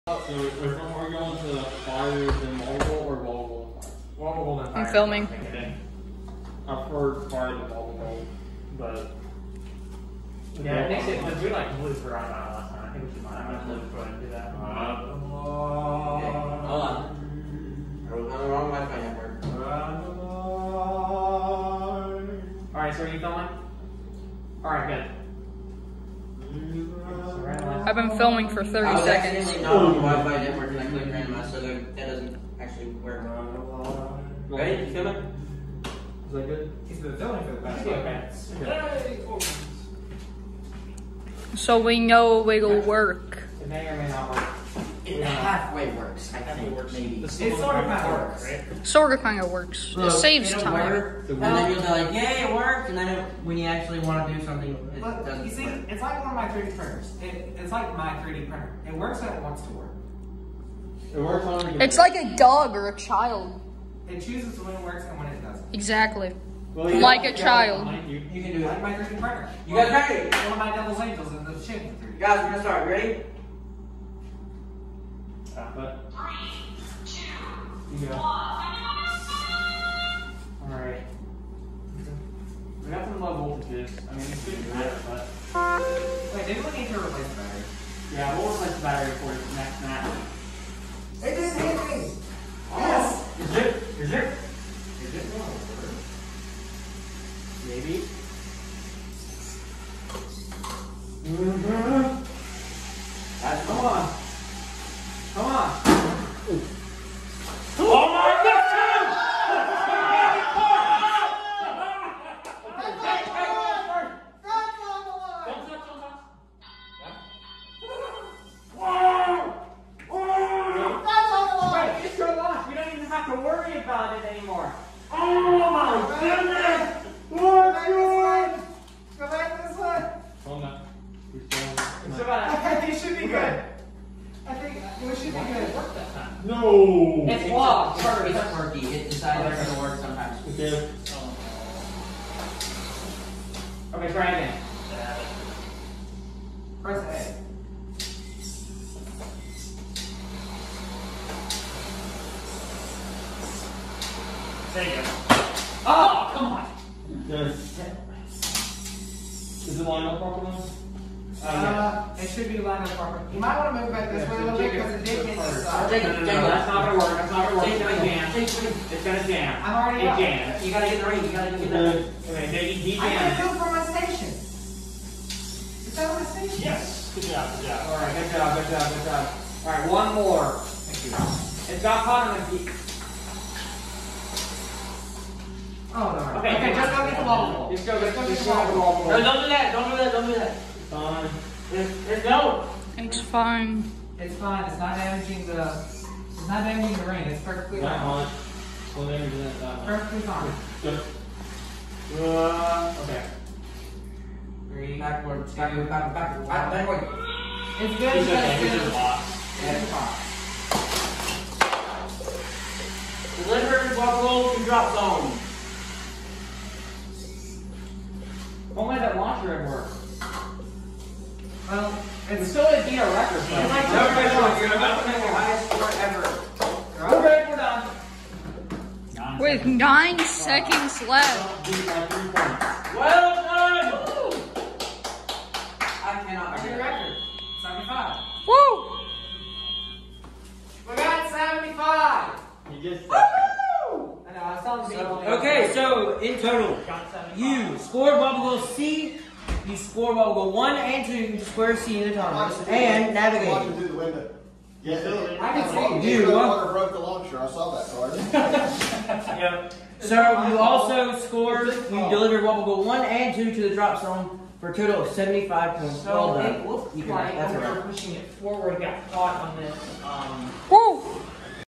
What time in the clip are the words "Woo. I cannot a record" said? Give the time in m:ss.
3:54.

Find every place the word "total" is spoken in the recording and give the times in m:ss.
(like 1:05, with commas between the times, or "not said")
4:06, 4:24.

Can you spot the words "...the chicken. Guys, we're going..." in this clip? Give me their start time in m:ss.
1:11.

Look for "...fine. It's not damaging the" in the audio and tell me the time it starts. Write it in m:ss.
3:14.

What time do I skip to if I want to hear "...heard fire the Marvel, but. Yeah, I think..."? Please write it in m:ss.
0:06.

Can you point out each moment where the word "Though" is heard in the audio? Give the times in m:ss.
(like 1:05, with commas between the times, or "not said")
3:43.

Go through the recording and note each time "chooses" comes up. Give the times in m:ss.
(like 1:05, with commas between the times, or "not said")
1:04.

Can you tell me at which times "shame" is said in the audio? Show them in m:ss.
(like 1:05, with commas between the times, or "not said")
not said.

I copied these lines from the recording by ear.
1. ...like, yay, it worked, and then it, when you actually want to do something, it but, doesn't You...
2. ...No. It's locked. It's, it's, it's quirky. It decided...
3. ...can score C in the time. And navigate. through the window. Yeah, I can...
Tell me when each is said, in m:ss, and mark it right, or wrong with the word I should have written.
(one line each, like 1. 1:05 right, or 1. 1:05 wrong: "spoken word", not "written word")
1. 0:51 right
2. 2:16 right
3. 4:11 wrong: "square", not "score".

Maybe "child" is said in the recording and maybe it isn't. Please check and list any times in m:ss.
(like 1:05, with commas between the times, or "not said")
1:02, 1:07.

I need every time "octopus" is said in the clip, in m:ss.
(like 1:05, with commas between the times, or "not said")
not said.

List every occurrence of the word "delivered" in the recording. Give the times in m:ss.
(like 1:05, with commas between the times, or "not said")
3:33, 4:22.